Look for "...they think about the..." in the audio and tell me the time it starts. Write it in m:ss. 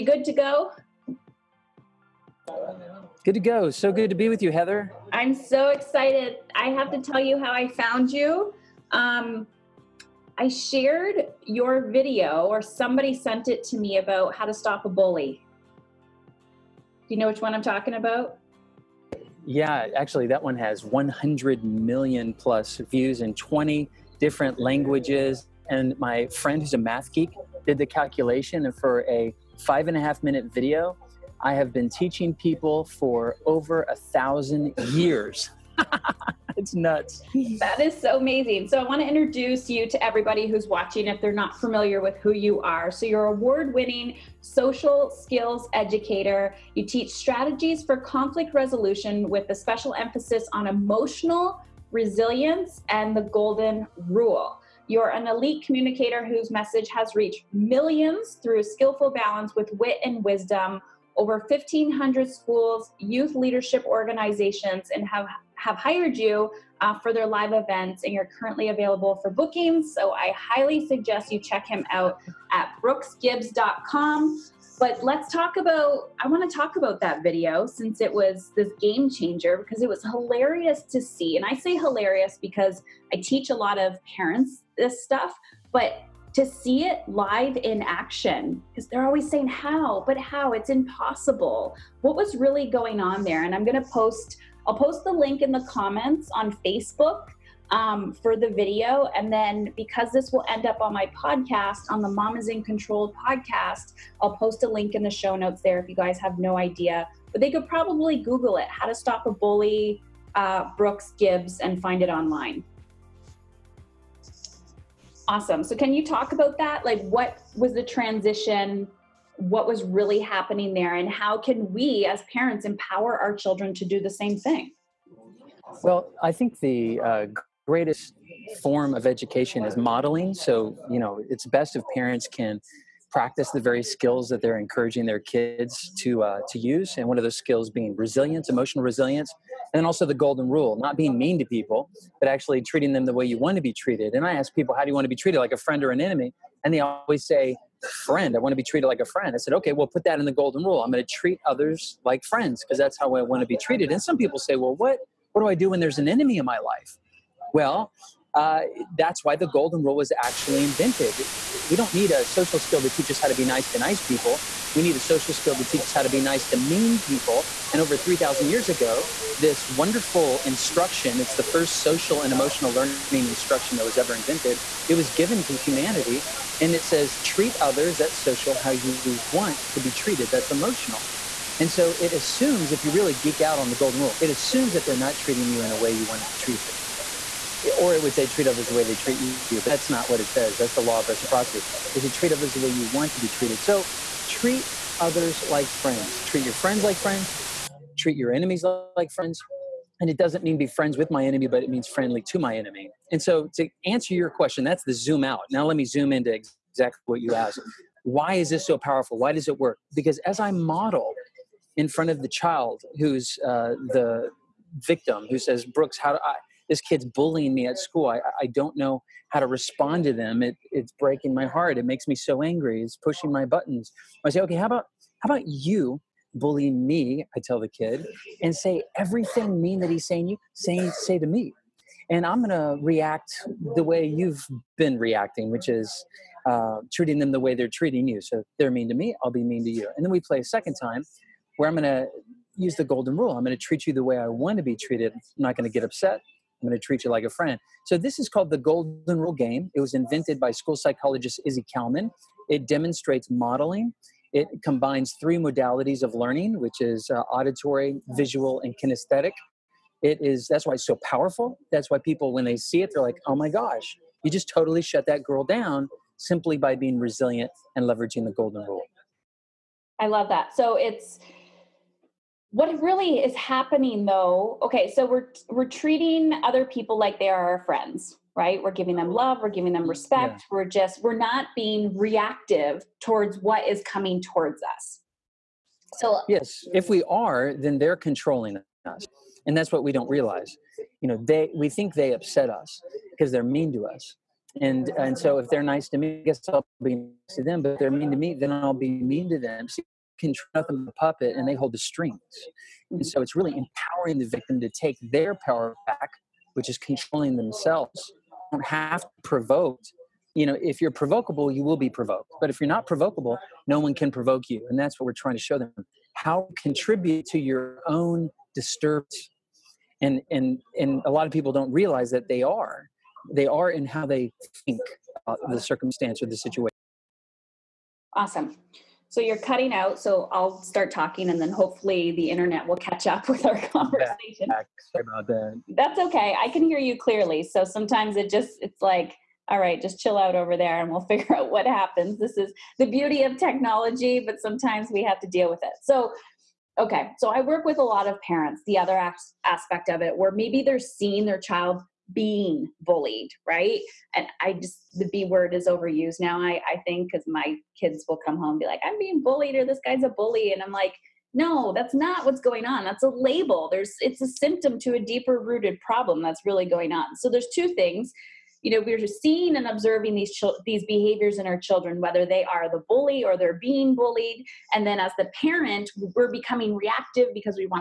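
5:24.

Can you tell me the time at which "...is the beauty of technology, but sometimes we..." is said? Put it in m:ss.
5:42.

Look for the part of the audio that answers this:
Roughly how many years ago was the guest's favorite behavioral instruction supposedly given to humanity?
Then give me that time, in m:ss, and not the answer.
2:47.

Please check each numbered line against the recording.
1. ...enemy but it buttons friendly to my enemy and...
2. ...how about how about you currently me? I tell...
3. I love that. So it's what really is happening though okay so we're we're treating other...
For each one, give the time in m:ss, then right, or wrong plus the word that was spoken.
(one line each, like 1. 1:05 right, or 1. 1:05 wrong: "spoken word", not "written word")
1. 3:21 wrong: "means", not "buttons"
2. 3:44 wrong: "bully", not "currently"
3. 4:29 right.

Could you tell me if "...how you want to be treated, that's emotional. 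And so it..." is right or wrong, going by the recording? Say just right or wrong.
right.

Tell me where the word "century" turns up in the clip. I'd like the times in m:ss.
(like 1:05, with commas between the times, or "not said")
not said.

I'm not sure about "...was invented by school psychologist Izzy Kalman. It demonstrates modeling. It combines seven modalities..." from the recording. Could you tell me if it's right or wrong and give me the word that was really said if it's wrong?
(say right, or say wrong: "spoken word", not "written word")
wrong: "three", not "seven".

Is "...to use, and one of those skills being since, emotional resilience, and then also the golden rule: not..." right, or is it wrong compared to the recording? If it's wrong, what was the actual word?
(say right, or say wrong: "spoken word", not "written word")
wrong: "resilience", not "since".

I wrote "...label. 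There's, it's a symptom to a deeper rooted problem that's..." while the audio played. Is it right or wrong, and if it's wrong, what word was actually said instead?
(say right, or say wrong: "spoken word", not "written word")
right.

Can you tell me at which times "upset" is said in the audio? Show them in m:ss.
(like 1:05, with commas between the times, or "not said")
4:05, 4:52.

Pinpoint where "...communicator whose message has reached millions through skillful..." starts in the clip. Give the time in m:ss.
0:55.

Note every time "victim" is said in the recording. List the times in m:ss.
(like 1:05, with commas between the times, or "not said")
3:34, 5:04.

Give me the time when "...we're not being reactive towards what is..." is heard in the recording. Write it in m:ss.
4:41.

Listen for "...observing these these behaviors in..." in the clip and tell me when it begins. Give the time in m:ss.
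6:09.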